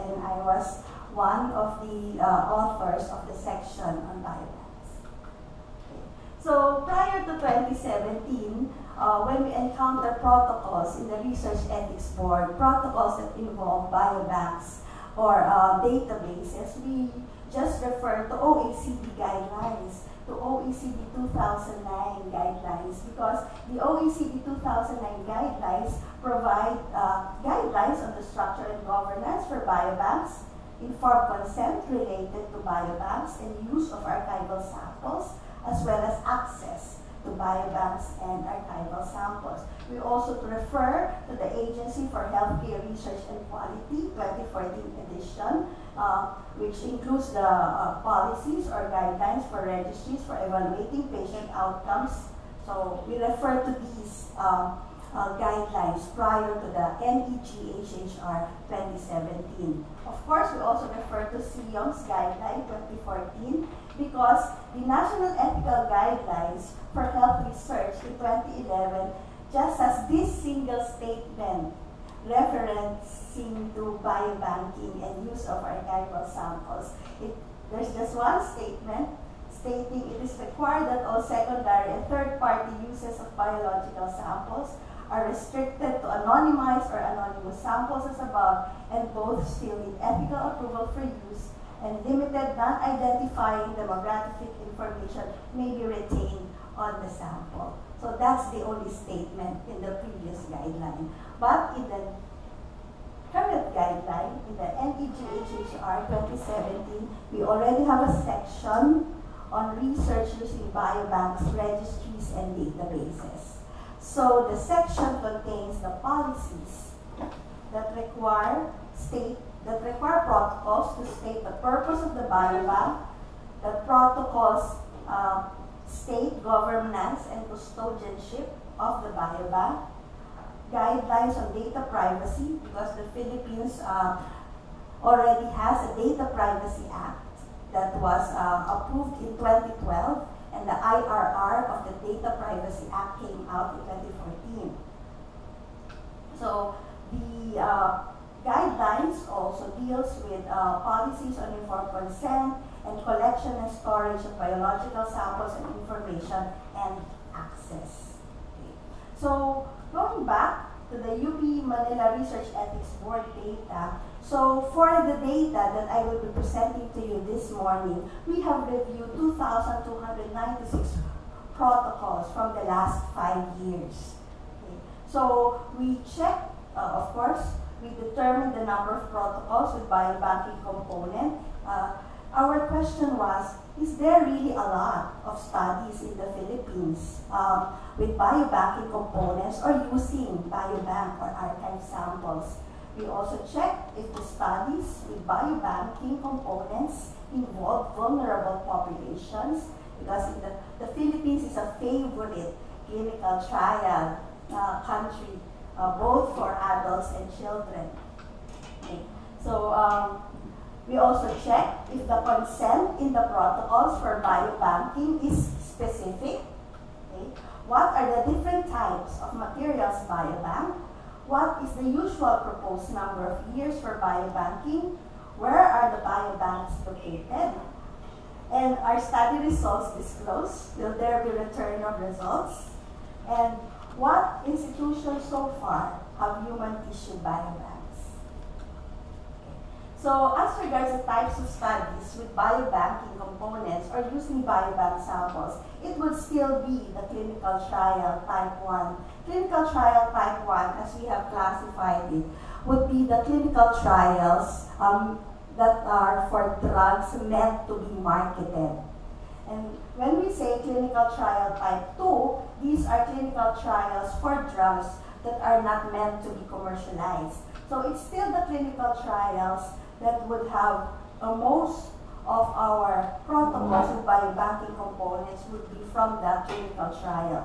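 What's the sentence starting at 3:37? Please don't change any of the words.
What are the different types of materials biobank?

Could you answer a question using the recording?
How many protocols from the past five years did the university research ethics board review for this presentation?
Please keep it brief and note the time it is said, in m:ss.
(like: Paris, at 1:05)
2,296, at 2:49.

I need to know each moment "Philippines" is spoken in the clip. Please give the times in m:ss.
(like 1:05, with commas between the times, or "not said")
2:13, 3:06, 3:20.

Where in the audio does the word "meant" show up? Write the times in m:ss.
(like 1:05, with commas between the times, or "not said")
4:17, 4:25.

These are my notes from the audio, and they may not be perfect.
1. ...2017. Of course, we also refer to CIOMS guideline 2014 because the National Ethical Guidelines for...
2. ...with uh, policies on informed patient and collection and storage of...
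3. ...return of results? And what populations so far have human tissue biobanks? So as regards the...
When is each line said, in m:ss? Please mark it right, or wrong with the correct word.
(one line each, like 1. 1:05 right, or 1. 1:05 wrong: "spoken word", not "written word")
1. 0:58 right
2. 2:30 wrong: "consent", not "patient"
3. 3:51 wrong: "institutions", not "populations".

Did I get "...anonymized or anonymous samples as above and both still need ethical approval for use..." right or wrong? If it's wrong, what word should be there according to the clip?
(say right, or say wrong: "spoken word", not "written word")
right.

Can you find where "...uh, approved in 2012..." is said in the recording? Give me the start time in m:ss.
2:18.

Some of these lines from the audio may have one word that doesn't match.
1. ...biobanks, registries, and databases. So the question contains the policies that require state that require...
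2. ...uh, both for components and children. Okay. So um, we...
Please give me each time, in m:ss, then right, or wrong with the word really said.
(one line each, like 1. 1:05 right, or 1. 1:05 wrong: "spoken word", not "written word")
1. 1:50 wrong: "section", not "question"
2. 3:25 wrong: "adults", not "components".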